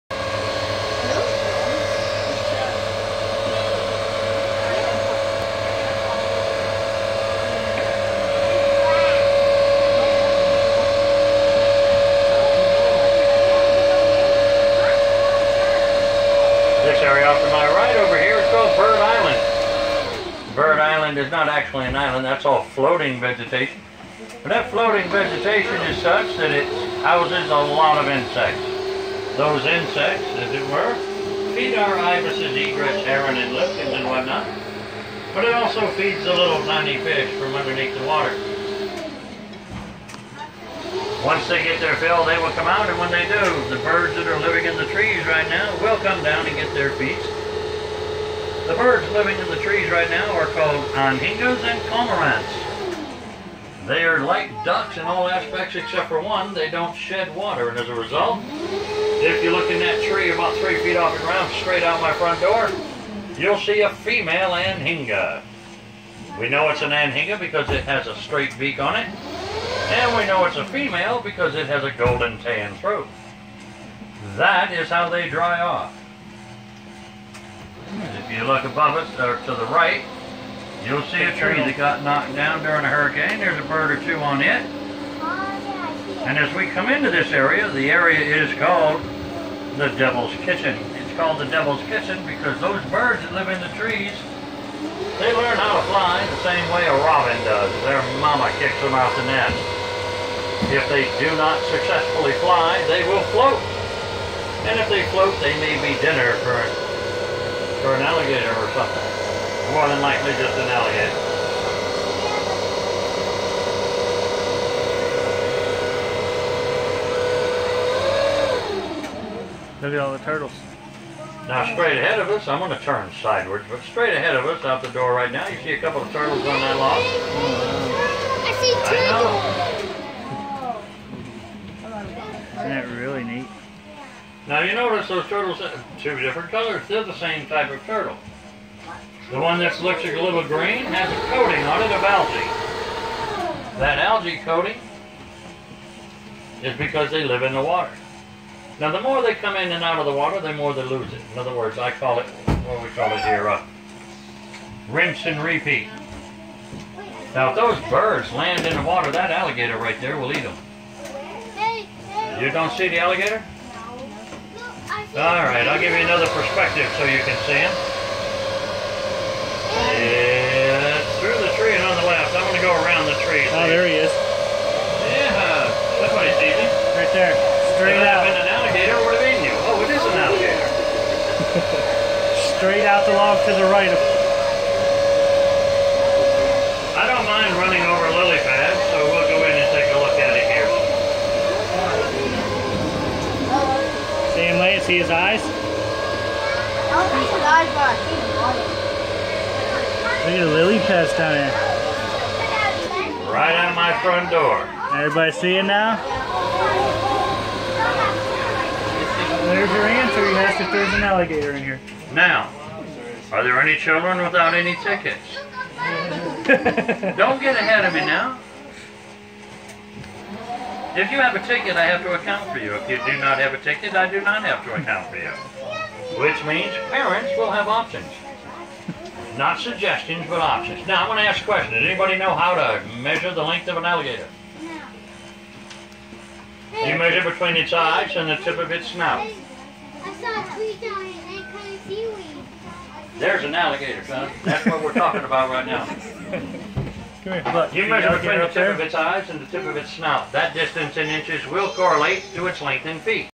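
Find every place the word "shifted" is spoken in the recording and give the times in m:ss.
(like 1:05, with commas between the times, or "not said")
not said.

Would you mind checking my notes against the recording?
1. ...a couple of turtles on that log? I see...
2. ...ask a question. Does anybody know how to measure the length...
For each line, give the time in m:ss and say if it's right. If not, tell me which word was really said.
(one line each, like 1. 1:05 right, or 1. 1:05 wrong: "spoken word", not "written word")
1. 2:05 right
2. 3:51 right.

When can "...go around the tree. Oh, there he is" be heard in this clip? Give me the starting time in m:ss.
2:52.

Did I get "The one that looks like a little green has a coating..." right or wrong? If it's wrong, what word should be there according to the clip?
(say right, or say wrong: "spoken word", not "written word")
right.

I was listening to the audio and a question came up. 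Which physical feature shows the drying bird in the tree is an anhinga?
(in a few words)
straight beak.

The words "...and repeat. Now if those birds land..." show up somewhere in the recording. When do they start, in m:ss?
2:35.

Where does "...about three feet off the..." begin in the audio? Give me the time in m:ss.
1:00.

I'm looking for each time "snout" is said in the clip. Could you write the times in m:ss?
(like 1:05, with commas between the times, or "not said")
3:58, 4:09.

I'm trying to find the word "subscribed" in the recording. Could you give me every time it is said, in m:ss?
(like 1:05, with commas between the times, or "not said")
not said.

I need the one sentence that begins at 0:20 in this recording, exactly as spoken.
Bird Island is not actually an island, that's all floating vegetation.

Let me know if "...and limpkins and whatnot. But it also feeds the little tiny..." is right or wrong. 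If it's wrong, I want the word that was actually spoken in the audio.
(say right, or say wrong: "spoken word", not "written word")
right.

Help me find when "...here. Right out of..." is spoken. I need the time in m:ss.
3:21.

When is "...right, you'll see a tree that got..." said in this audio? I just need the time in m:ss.
1:19.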